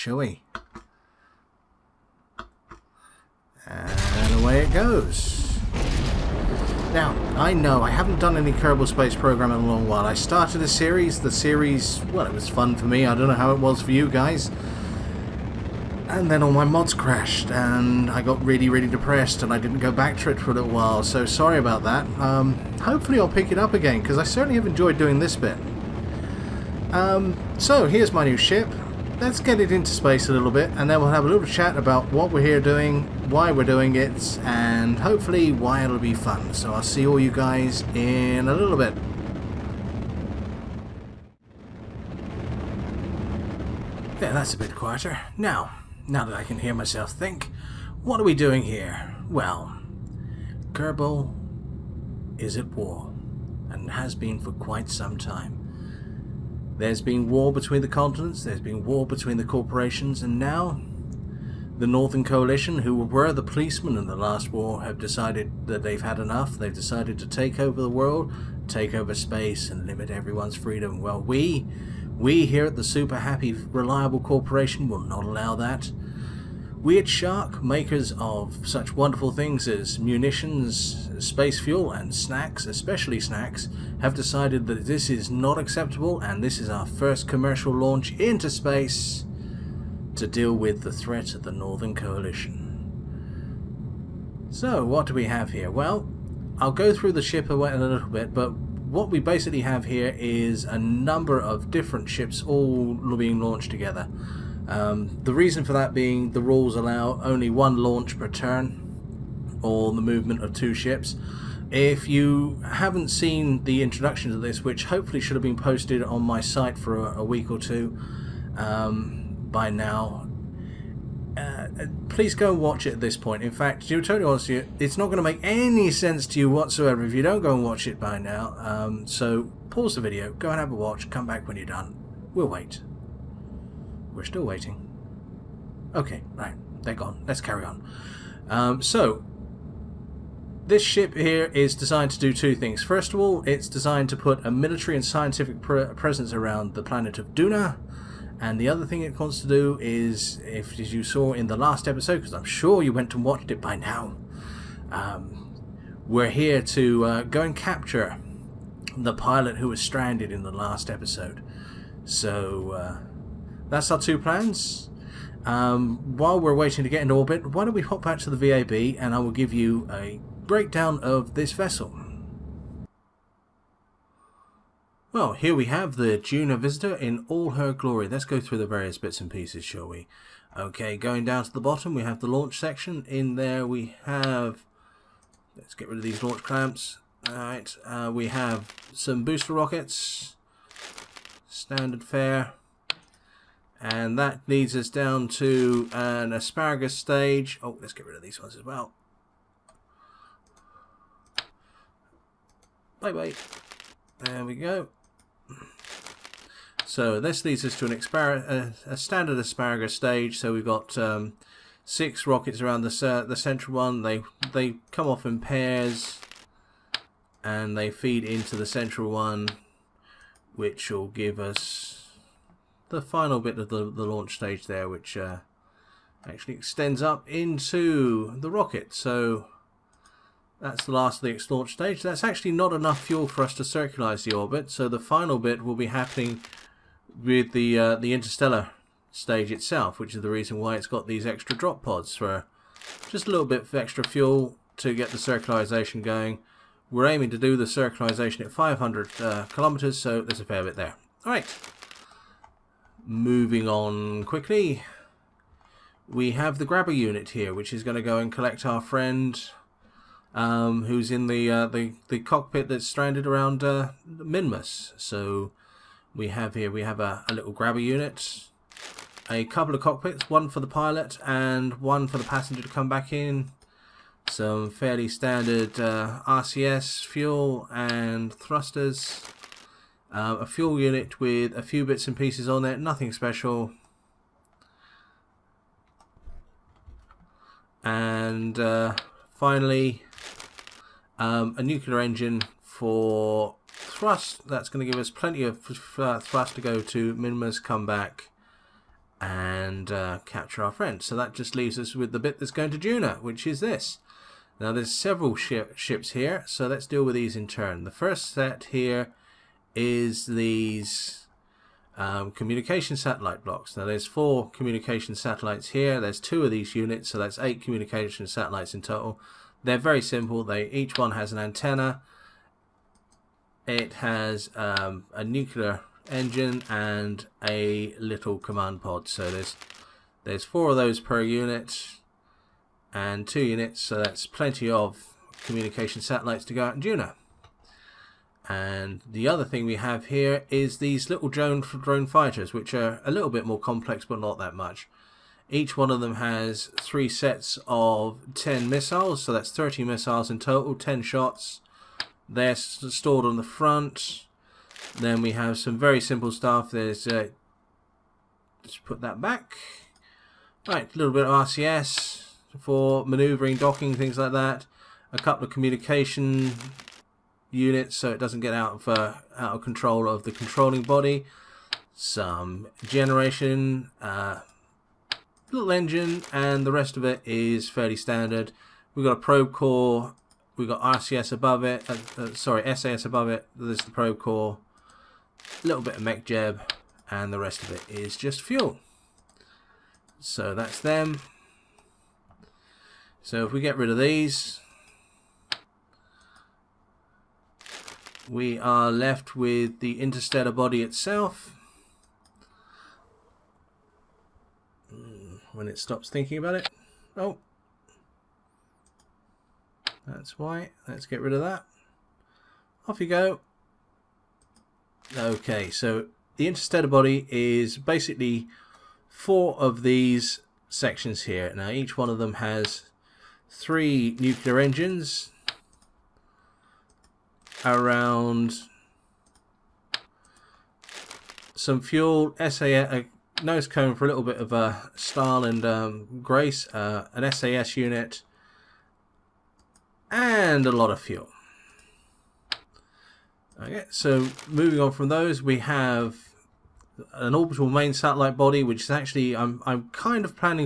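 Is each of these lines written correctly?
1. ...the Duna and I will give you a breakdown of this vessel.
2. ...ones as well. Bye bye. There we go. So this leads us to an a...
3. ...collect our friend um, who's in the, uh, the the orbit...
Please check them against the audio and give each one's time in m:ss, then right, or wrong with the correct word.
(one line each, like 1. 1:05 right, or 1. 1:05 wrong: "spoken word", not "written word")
1. 2:48 wrong: "VAB", not "Duna"
2. 3:18 right
3. 4:18 wrong: "cockpit", not "orbit".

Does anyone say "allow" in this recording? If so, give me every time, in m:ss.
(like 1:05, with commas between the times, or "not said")
1:15, 1:46.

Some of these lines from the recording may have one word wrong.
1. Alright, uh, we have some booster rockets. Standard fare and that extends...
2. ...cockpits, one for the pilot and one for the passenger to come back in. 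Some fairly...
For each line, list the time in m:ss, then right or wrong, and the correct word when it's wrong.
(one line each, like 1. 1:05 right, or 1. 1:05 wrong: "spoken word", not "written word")
1. 3:07 wrong: "leads", not "extends"
2. 4:29 right.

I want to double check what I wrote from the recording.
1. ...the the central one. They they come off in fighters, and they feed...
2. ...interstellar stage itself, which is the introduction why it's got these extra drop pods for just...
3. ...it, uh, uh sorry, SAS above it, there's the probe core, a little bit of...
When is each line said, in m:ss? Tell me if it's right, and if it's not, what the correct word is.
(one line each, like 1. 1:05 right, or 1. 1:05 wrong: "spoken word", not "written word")
1. 3:32 wrong: "pairs", not "fighters"
2. 3:58 wrong: "reason", not "introduction"
3. 6:21 right.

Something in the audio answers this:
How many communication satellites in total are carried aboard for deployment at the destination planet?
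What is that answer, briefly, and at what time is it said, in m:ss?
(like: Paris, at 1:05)
8, at 5:17.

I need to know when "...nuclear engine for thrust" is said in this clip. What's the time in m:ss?
4:51.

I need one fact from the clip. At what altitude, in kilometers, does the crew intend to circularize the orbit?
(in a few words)
500.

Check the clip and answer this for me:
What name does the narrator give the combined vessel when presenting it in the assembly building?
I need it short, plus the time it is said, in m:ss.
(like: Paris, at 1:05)
Juno Visitor, at 2:56.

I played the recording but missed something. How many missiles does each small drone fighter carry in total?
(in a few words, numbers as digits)
30.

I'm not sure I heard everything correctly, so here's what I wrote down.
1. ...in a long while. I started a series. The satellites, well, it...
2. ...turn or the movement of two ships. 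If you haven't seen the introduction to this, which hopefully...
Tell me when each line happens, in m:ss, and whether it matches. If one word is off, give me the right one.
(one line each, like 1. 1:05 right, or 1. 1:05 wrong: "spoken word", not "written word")
1. 0:09 wrong: "series", not "satellites"
2. 1:48 right.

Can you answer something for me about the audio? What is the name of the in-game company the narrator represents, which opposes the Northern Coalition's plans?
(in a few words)
Super Happy Reliable Corporation.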